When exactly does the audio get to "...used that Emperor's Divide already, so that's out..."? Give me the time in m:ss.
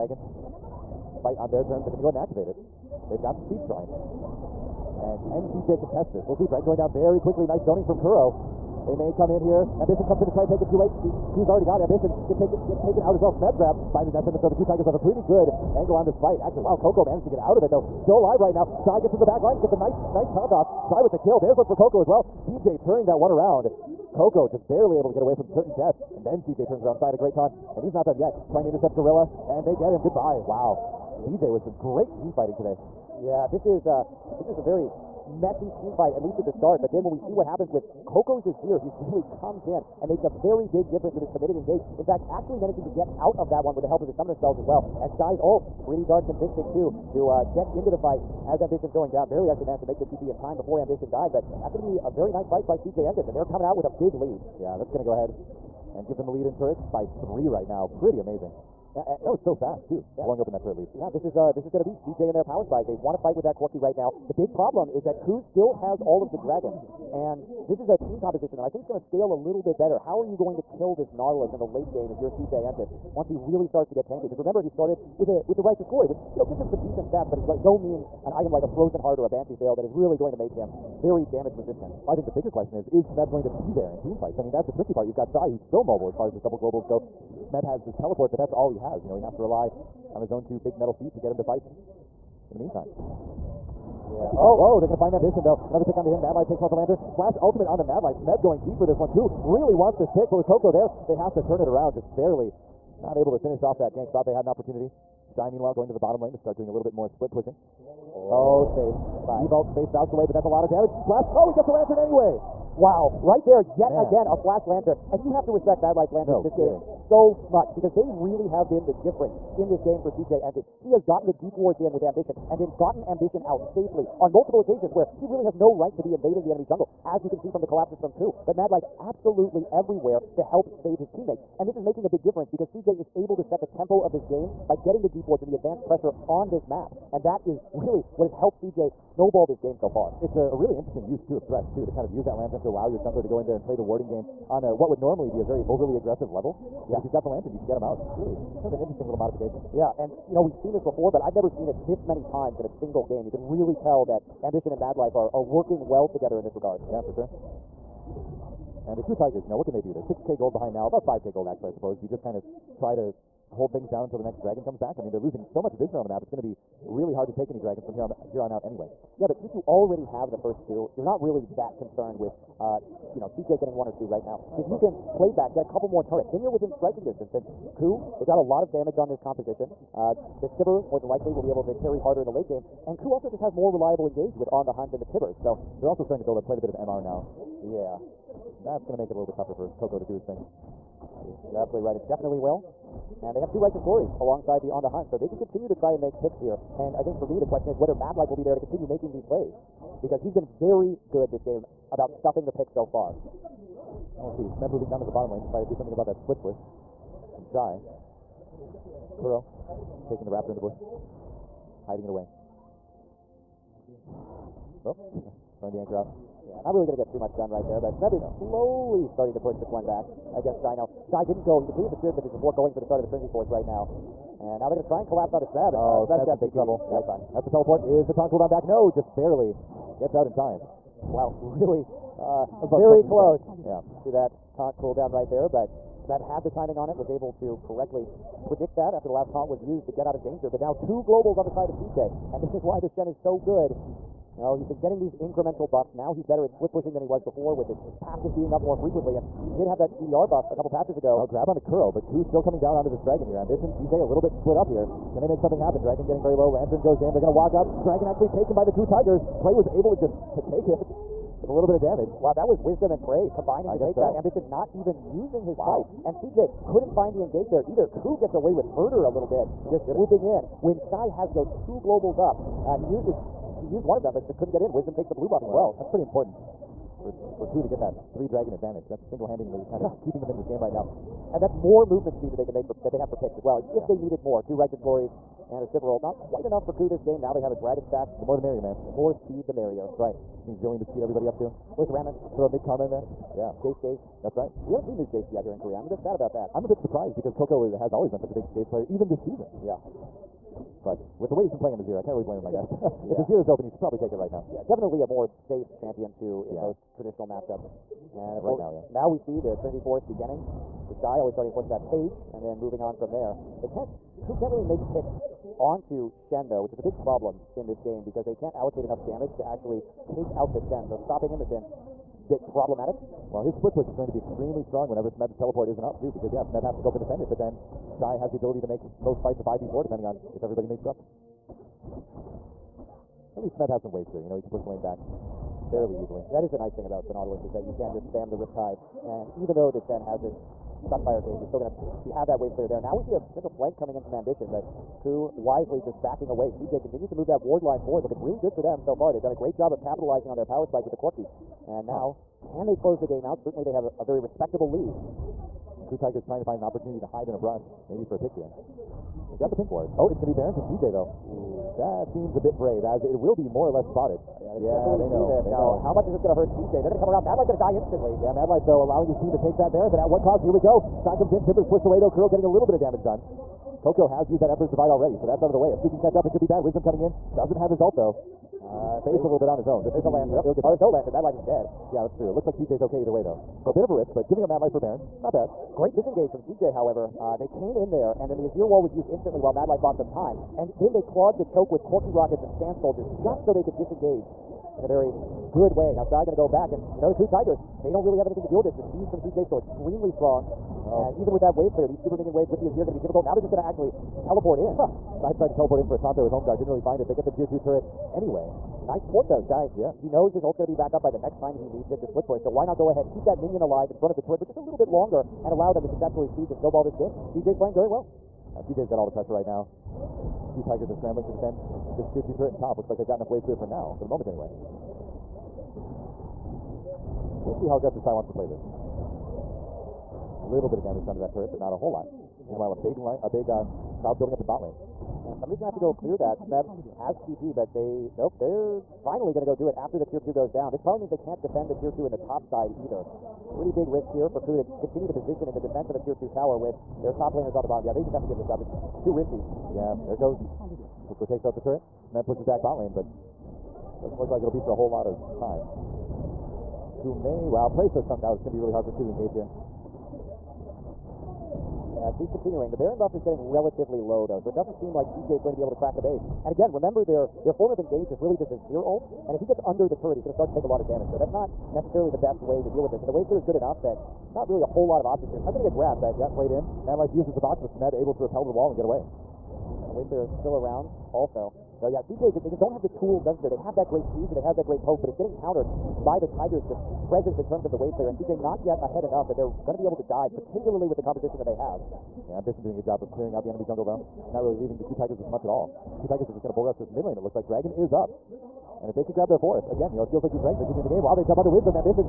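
6:14.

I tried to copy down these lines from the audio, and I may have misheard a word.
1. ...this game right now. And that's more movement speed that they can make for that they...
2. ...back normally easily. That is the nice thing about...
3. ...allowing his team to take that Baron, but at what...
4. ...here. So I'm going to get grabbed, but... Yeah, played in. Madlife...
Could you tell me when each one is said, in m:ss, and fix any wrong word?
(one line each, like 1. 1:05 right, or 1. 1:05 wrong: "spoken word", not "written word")
1. 4:40 right
2. 5:34 wrong: "fairly", not "normally"
3. 6:08 right
4. 7:55 right.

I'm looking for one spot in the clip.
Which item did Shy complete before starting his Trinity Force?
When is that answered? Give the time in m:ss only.
3:41.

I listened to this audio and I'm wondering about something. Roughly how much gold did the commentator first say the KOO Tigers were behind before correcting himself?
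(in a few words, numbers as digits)
6K.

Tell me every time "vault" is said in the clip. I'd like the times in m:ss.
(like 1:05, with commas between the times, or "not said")
1:49.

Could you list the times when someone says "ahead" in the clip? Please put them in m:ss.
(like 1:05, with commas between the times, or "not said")
0:02, 0:55, 6:52, 8:08.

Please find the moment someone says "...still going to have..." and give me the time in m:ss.
5:41.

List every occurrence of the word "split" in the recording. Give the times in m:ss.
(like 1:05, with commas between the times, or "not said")
1:47, 3:26, 4:06, 4:14, 5:23, 6:52.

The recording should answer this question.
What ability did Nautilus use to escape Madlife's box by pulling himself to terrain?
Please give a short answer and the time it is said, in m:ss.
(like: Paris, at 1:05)
anchor, at 3:35.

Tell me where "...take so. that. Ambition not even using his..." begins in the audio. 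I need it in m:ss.
4:23.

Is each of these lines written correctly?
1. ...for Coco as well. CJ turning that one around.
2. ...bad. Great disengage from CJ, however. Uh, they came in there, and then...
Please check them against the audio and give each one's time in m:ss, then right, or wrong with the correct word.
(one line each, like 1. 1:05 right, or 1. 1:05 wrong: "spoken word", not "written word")
1. 0:21 right
2. 6:25 right.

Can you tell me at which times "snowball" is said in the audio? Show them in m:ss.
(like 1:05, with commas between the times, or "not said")
2:18, 6:56.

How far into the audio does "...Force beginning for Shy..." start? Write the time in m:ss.
5:09.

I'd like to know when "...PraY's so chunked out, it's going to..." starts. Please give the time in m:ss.
7:37.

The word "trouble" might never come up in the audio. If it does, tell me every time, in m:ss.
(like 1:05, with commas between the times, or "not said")
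3:46.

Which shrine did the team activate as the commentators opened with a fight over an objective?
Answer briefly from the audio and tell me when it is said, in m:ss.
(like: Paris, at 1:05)
Speed Shrine, at 0:03.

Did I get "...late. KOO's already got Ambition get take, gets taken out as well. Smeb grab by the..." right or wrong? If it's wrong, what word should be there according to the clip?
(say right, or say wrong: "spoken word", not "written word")
right.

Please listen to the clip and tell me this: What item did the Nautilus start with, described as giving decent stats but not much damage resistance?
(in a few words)
Righteous Glory.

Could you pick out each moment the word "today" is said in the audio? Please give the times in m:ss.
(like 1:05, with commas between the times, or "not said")
0:32.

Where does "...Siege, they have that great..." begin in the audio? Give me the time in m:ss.
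8:04.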